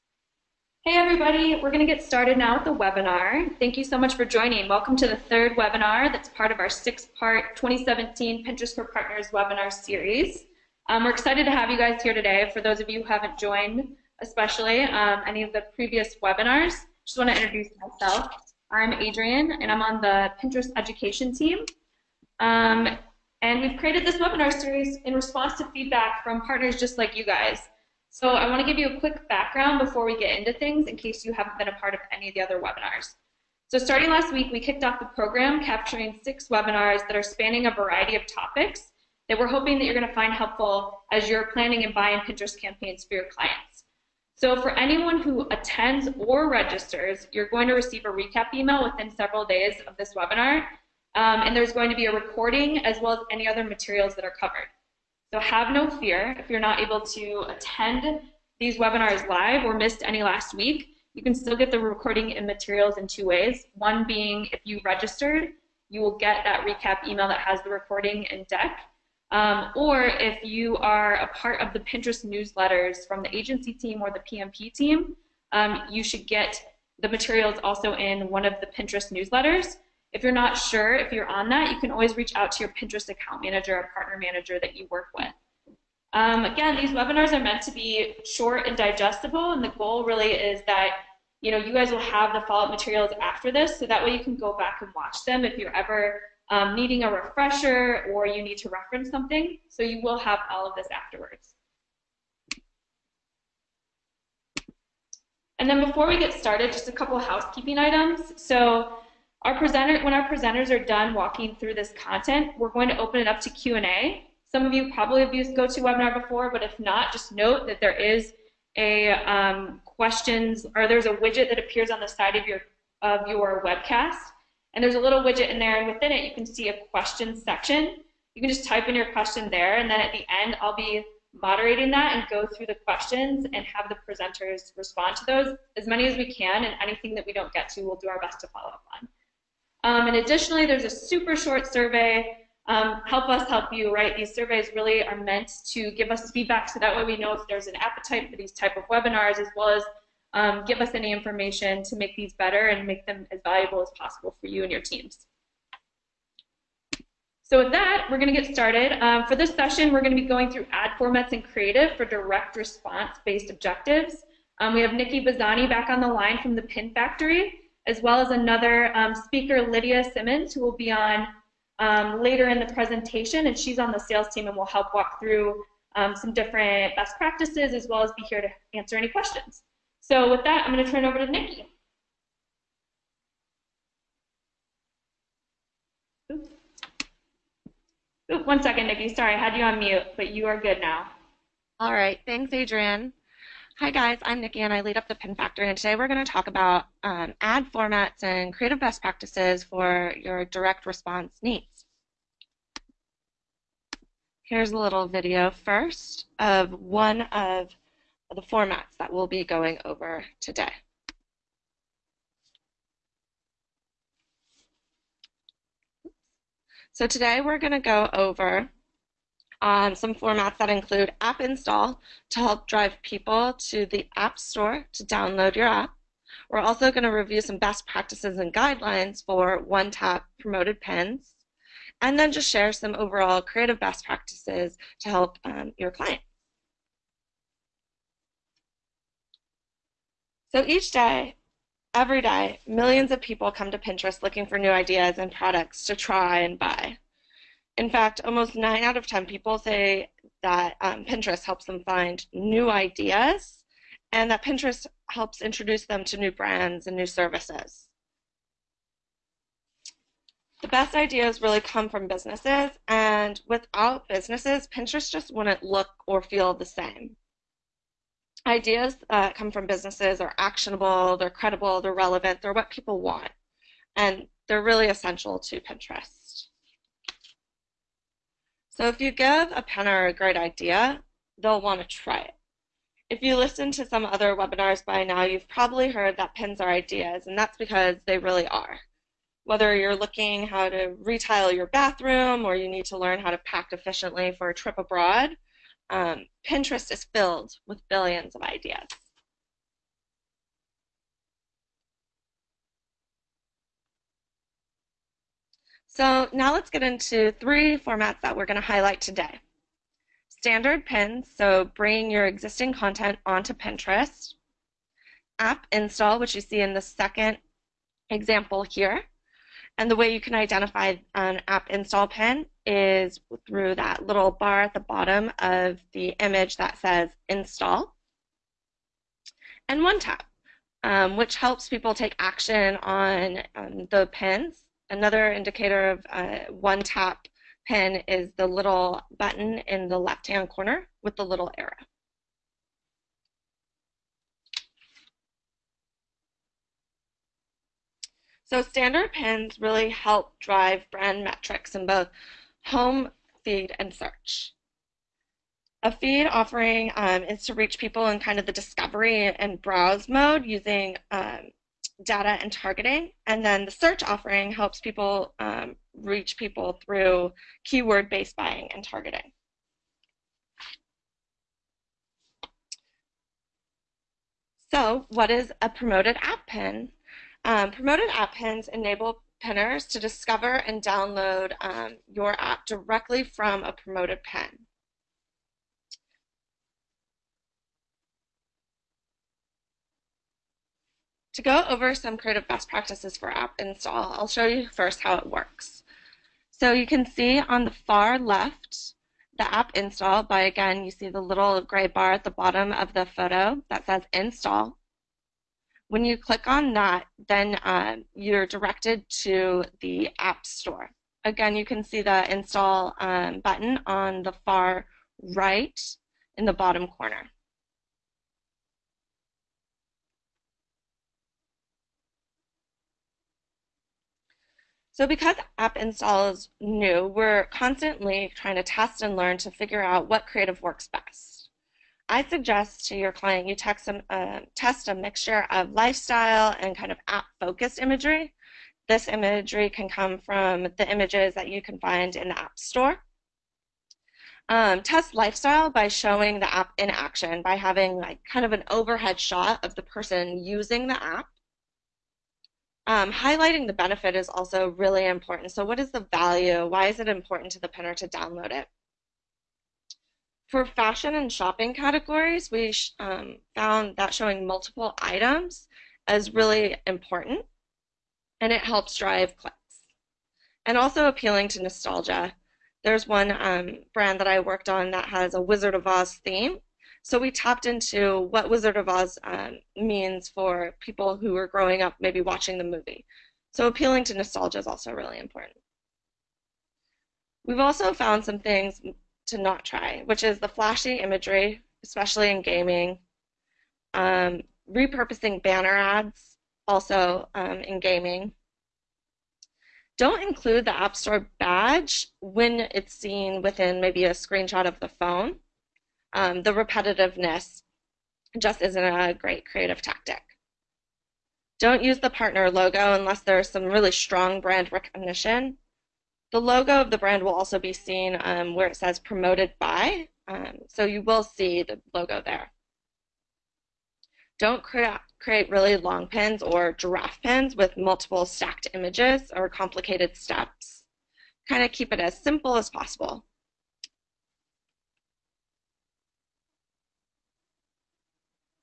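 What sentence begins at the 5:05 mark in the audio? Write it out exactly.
So now let's get into three formats that we're going to highlight today.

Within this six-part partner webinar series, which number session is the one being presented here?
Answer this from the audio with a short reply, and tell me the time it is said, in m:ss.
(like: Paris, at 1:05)
third, at 0:05.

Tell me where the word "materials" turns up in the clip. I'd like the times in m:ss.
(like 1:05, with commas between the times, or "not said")
0:53, 1:02, 1:17, 1:32.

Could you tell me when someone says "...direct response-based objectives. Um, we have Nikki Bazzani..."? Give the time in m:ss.
2:42.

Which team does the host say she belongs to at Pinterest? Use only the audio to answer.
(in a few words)
education team.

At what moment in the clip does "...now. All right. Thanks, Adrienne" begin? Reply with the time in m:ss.
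3:10.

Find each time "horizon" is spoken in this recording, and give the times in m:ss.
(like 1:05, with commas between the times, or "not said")
not said.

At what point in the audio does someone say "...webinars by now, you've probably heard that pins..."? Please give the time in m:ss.
4:44.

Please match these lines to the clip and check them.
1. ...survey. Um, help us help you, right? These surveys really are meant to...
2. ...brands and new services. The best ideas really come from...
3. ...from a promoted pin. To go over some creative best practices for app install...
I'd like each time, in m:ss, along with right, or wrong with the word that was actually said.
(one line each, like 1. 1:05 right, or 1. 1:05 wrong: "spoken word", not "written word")
1. 2:21 right
2. 4:16 right
3. 6:23 right.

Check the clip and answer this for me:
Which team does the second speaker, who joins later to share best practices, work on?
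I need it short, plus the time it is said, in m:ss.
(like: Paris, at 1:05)
sales team, at 2:53.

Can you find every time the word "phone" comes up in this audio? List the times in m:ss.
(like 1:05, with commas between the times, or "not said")
8:24.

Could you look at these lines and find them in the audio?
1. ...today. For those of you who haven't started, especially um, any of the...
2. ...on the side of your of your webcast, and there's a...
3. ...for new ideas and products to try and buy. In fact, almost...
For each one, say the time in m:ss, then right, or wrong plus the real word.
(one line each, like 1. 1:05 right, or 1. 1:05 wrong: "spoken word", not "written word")
1. 0:12 wrong: "joined", not "started"
2. 2:01 right
3. 4:04 right.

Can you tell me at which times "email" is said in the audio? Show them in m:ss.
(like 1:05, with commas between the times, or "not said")
0:48, 1:07.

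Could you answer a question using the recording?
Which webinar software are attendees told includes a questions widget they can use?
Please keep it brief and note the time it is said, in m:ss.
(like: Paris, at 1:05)
GoToWebinar, at 1:55.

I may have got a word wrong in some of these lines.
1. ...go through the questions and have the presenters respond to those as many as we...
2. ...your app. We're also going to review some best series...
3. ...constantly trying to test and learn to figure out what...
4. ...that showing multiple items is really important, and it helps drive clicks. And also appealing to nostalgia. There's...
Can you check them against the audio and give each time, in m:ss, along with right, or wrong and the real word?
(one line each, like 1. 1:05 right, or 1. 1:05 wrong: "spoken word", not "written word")
1. 2:12 right
2. 3:45 wrong: "practices", not "series"
3. 7:07 right
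4. 7:43 right.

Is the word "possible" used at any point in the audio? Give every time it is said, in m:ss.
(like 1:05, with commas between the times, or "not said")
2:33, 8:52.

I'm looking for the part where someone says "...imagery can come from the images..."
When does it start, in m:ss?
7:19.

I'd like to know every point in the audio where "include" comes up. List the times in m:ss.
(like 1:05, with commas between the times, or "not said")
3:40, 8:20.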